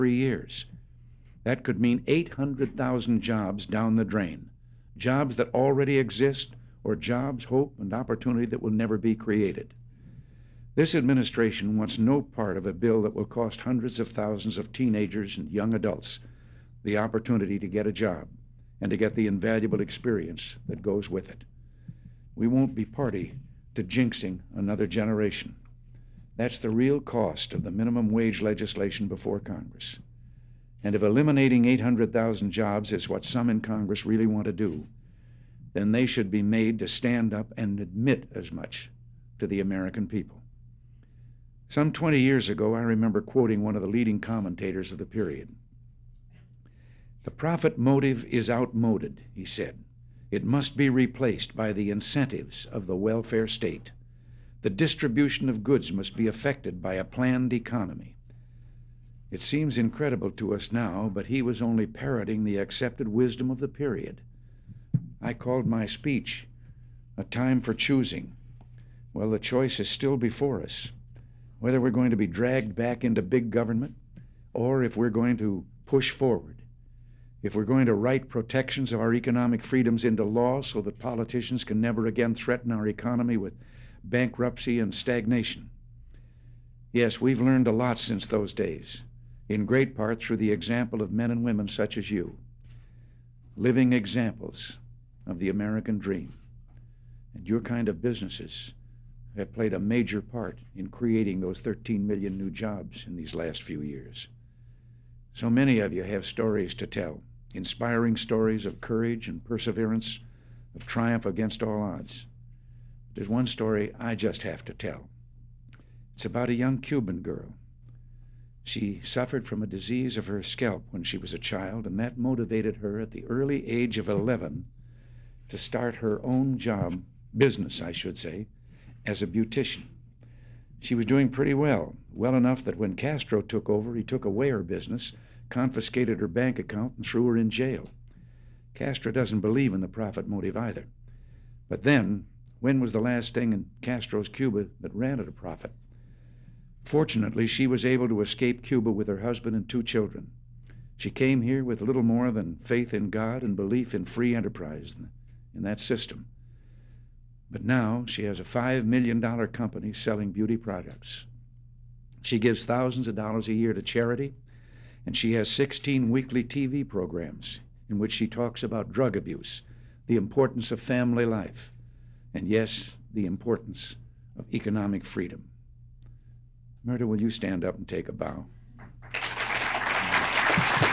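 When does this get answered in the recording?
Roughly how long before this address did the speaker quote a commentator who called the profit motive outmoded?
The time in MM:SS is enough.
00:41.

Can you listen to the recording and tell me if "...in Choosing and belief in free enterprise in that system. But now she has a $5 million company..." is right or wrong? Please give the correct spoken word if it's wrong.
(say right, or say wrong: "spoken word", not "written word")
wrong: "God", not "Choosing".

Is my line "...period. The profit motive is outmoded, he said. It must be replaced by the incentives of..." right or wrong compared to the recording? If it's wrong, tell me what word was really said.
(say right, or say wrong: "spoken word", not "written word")
right.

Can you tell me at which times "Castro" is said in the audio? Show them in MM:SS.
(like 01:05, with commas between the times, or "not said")
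02:12, 02:18, 02:23.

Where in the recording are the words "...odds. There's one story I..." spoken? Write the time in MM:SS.
01:51.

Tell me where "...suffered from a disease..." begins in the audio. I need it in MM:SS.
01:59.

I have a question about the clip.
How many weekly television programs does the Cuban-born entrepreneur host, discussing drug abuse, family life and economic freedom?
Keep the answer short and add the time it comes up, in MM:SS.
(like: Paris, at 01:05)
16, at 02:45.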